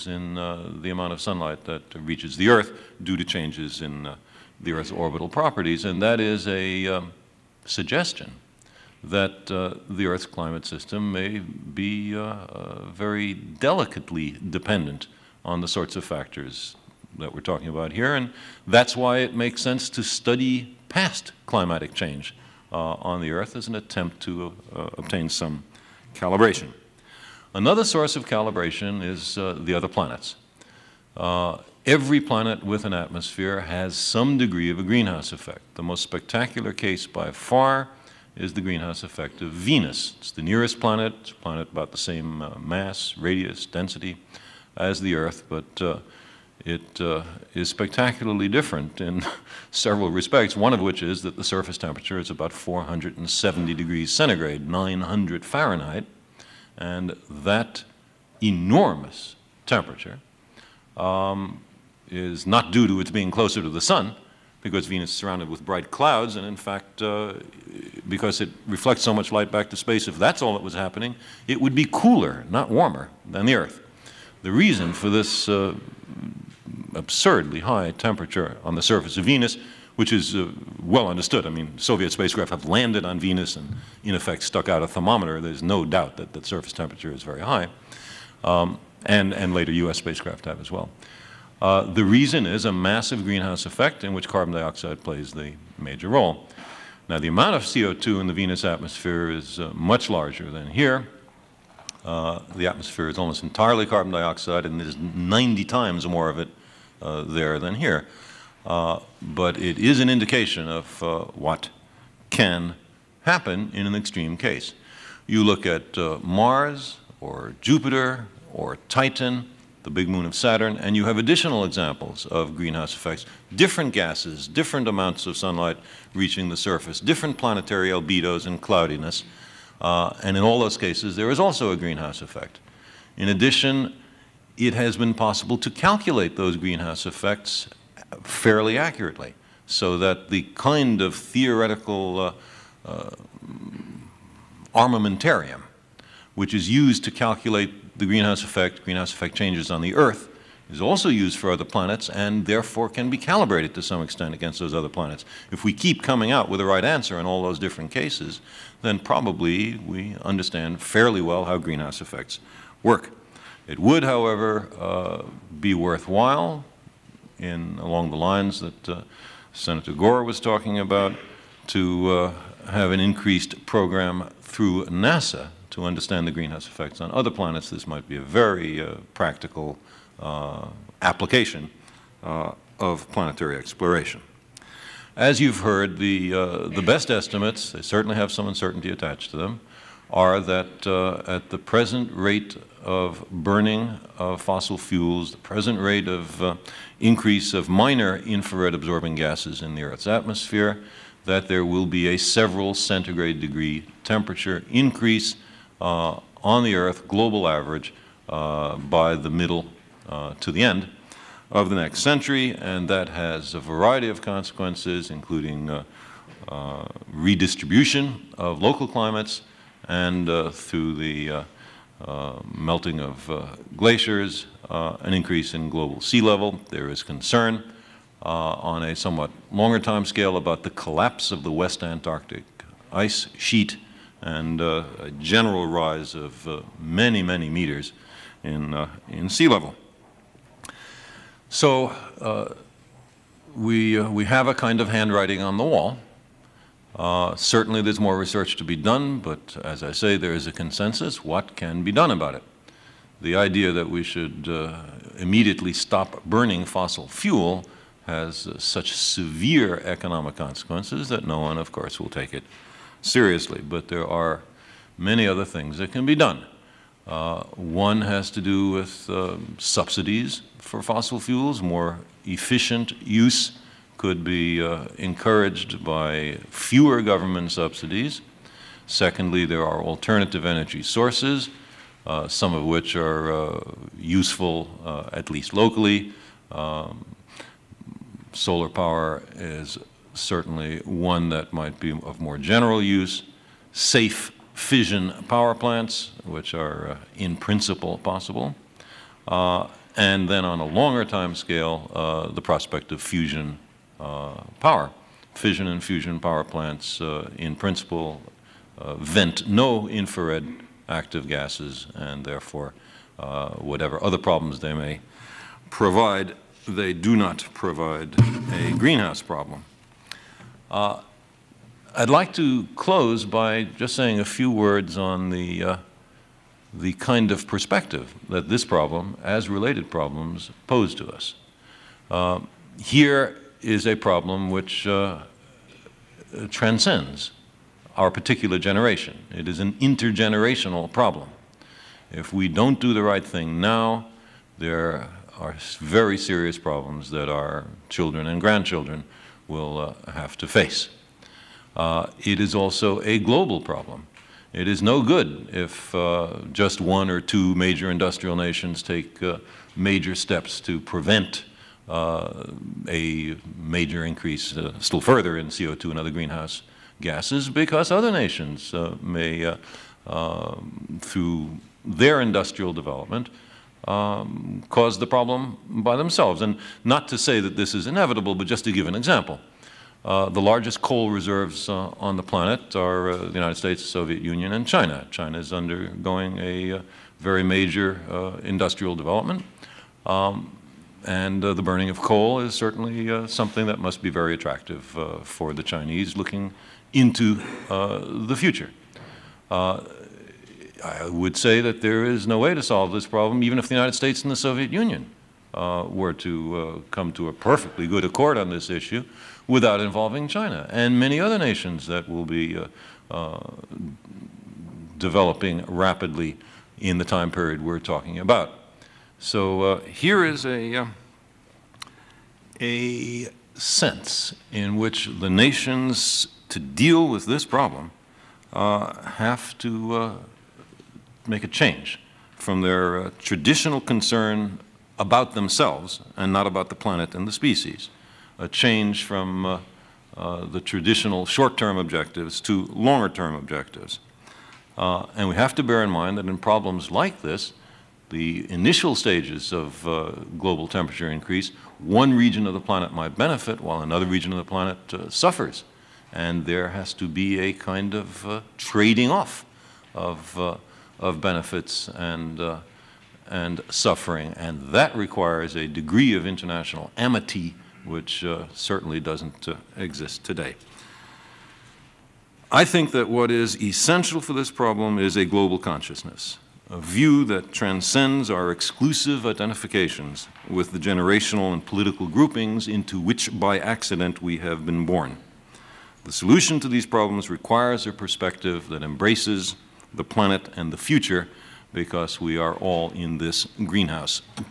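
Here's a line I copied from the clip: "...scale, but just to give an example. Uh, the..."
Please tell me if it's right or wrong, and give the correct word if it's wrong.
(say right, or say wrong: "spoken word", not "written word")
wrong: "inevitable", not "scale".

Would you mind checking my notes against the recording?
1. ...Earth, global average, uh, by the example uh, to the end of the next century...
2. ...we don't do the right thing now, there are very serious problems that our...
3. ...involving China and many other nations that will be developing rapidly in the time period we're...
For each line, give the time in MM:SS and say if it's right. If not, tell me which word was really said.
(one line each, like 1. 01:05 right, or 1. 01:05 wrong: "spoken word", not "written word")
1. 03:26 wrong: "middle", not "example"
2. 05:42 right
3. 06:49 right.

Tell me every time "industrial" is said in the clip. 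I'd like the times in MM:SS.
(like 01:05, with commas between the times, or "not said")
05:57, 06:12, 06:28.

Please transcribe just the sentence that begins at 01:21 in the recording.
I mean, Soviet spacecraft have landed on Venus and, in effect, stuck out a thermometer.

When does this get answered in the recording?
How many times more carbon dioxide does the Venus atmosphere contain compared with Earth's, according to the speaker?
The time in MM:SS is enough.
01:44.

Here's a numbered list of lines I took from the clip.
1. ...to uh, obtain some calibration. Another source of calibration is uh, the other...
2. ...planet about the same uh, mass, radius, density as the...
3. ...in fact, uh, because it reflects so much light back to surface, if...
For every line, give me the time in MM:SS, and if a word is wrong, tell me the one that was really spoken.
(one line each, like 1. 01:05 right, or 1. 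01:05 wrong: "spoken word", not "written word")
1. 00:24 right
2. 00:41 right
3. 01:06 wrong: "space", not "surface".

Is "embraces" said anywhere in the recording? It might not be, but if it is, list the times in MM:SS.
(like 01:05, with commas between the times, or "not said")
08:08.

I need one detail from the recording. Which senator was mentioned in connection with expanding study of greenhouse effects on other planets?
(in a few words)
Senator Gore.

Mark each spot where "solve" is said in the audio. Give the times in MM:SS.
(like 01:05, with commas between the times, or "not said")
06:42.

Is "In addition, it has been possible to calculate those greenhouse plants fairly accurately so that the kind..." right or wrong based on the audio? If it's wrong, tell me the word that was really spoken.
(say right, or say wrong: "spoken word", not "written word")
wrong: "effects", not "plants".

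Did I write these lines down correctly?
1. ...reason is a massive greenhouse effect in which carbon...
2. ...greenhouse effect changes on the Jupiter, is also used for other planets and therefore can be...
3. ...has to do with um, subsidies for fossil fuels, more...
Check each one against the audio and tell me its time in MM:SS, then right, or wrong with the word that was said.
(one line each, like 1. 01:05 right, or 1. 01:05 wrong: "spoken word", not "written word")
1. 01:32 right
2. 02:28 wrong: "Earth", not "Jupiter"
3. 04:28 right.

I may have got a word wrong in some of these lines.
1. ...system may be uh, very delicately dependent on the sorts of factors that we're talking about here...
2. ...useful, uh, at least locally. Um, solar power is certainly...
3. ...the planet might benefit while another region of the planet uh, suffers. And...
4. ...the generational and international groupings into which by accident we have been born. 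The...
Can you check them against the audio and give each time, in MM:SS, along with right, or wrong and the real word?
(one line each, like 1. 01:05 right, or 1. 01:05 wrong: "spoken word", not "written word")
1. 00:10 right
2. 04:43 right
3. 07:32 right
4. 08:00 wrong: "political", not "international".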